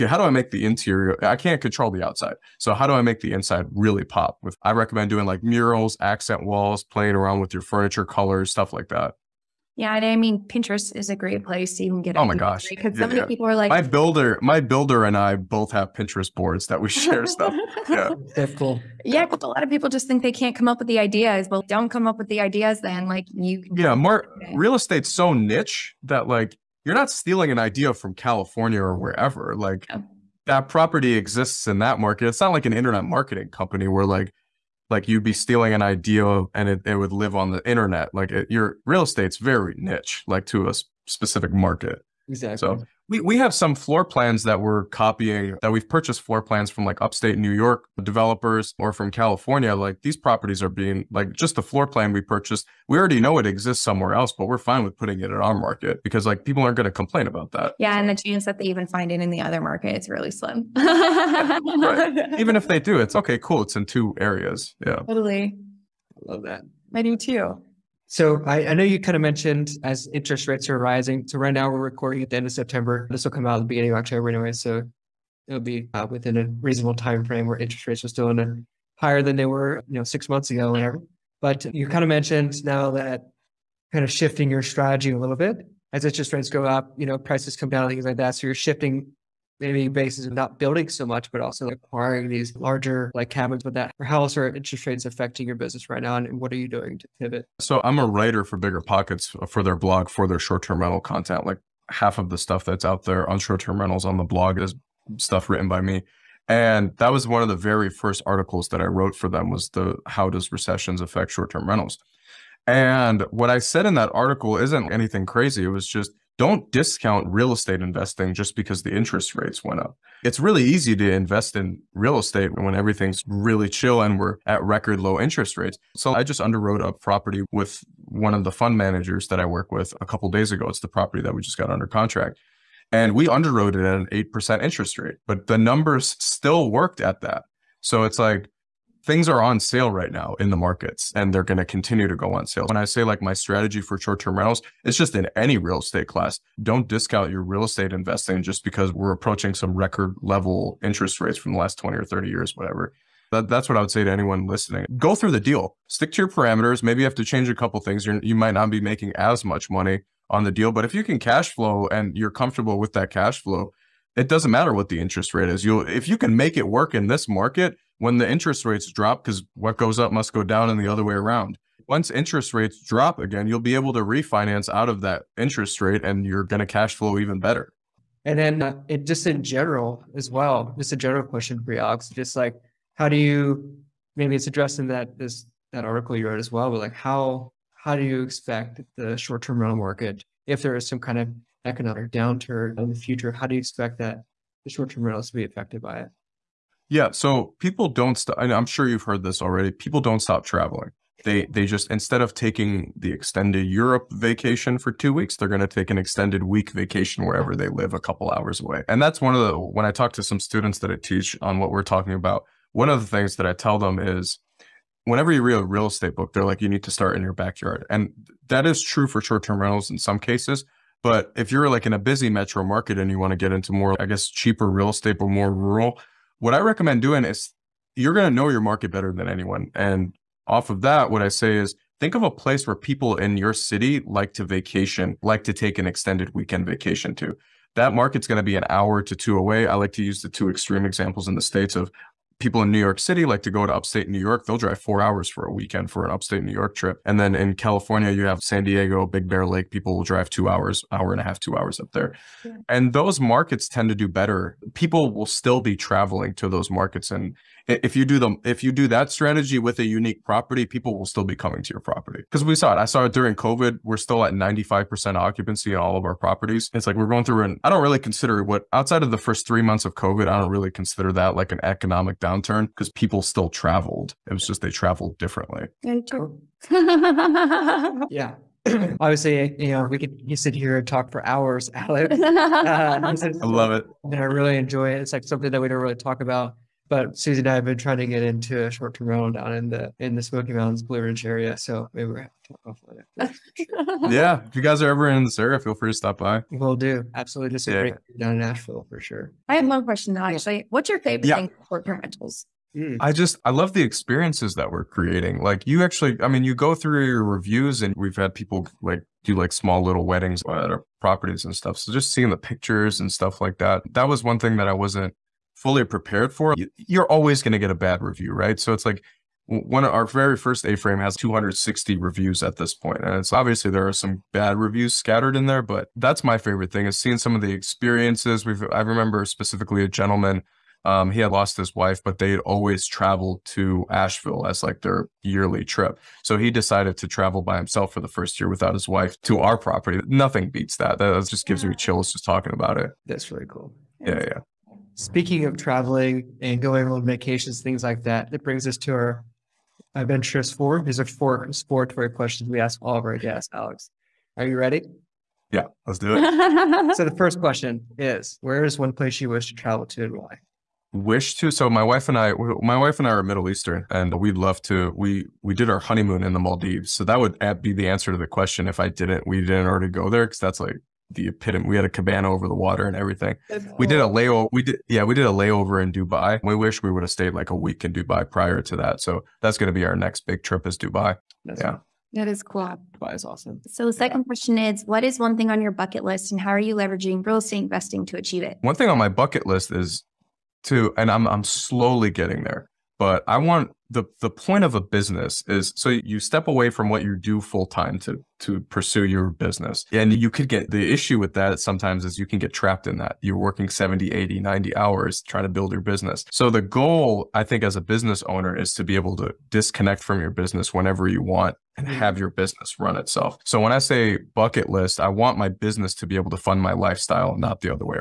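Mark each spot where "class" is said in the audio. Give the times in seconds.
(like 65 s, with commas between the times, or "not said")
146 s.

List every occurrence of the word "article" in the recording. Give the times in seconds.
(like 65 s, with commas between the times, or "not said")
108 s, 114 s, 185 s.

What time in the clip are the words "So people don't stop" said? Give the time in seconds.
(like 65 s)
197 s.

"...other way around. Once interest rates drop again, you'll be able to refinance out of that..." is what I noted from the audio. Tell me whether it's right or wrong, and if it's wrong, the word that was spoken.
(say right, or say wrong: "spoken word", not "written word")
right.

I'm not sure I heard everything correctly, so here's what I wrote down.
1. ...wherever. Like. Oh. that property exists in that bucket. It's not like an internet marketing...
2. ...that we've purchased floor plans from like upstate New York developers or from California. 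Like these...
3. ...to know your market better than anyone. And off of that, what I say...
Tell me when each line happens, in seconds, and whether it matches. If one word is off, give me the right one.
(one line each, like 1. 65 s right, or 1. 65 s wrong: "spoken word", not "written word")
1. 28 s wrong: "market", not "bucket"
2. 45 s right
3. 228 s right.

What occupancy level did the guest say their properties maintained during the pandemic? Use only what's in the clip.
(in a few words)
95%.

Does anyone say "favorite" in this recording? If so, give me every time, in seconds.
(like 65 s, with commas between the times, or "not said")
300 s, 326 s.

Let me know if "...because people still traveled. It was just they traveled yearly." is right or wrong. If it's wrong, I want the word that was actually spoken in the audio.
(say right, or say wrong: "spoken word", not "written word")
wrong: "differently", not "yearly".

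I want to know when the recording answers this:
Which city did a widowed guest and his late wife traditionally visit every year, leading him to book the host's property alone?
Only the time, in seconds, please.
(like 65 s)
333 s.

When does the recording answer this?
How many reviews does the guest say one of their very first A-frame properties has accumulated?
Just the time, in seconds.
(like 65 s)
321 s.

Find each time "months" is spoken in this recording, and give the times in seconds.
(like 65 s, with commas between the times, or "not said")
80 s, 269 s.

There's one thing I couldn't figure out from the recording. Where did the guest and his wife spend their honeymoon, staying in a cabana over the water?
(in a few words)
Maldives.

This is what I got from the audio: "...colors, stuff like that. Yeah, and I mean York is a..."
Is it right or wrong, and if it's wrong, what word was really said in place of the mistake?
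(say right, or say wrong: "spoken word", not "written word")
wrong: "Pinterest", not "York".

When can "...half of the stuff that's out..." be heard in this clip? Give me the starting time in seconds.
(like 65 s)
101 s.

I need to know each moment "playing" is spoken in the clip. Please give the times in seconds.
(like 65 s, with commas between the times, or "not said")
6 s.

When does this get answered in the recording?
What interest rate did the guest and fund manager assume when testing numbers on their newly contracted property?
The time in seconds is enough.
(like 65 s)
134 s.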